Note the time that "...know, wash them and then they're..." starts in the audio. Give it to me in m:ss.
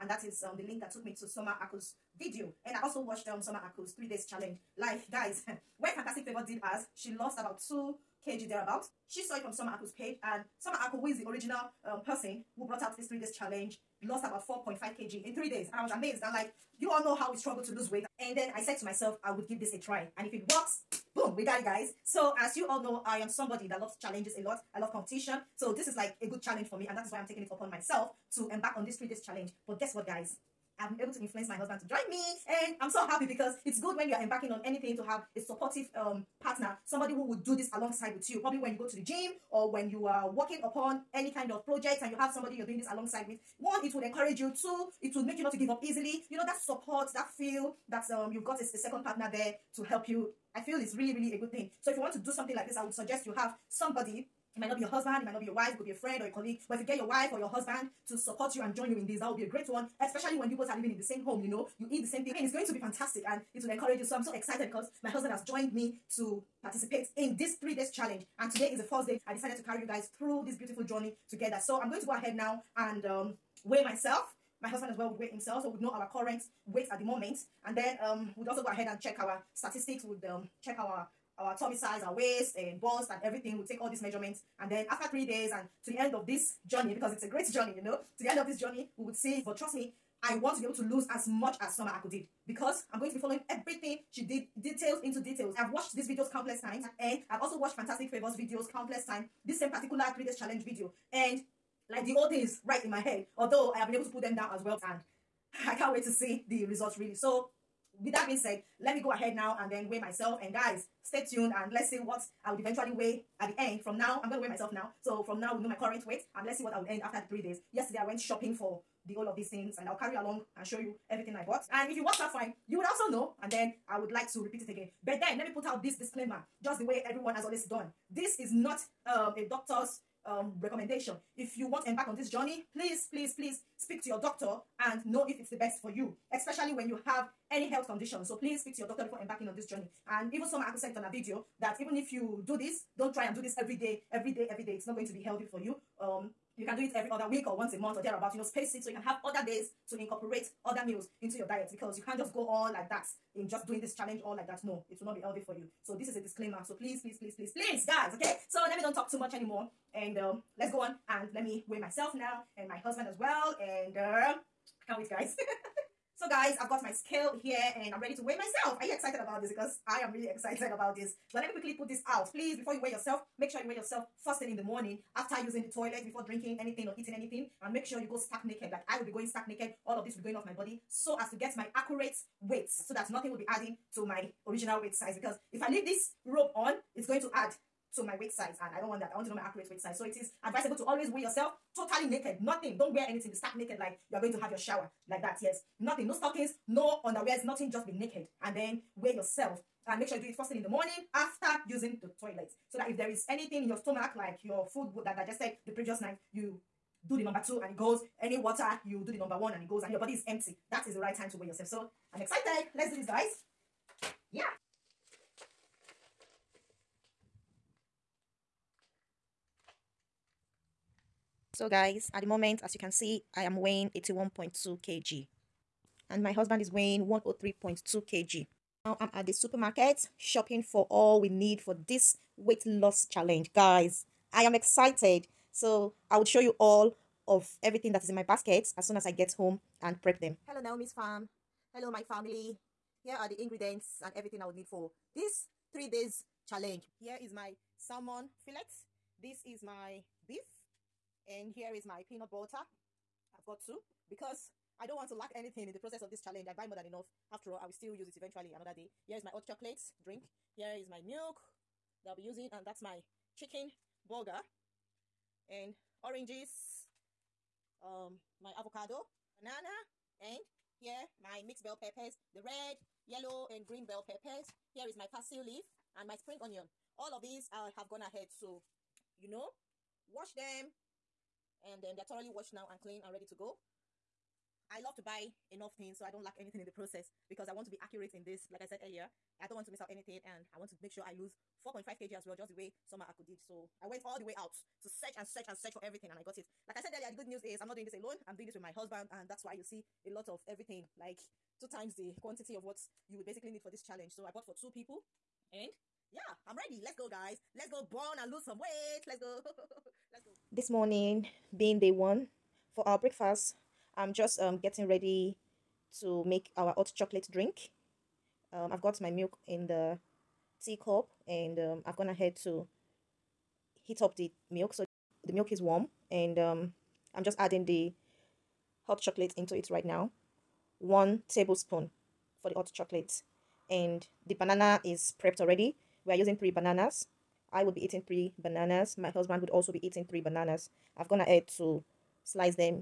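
4:39.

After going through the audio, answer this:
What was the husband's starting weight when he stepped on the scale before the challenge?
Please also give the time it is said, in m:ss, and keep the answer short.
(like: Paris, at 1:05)
103.2 kg, at 3:47.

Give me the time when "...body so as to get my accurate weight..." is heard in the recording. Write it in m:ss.
3:00.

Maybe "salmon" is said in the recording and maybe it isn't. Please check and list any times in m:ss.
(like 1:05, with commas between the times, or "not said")
4:07.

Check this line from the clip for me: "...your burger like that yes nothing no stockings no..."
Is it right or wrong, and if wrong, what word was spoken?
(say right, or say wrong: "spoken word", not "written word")
wrong: "shower", not "burger".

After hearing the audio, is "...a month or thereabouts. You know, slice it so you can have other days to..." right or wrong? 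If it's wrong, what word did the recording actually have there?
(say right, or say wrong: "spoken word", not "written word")
wrong: "space", not "slice".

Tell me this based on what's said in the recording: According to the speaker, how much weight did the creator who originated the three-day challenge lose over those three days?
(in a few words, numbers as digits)
4.5 kg.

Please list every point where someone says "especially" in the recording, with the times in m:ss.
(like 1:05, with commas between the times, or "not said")
1:00, 2:16.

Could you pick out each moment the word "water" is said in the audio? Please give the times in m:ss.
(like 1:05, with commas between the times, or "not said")
3:28.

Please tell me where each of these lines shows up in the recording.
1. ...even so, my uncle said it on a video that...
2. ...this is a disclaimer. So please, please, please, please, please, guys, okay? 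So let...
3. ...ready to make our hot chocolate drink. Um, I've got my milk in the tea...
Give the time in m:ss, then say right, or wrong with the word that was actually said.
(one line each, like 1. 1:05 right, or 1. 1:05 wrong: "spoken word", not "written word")
1. 2:20 right
2. 2:35 right
3. 5:14 right.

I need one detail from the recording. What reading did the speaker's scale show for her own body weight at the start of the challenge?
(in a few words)
81.2 kg.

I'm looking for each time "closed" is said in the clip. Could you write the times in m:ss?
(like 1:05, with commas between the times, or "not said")
not said.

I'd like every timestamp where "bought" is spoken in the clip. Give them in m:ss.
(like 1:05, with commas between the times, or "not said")
2:01, 5:04.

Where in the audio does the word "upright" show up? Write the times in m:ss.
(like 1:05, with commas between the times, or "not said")
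not said.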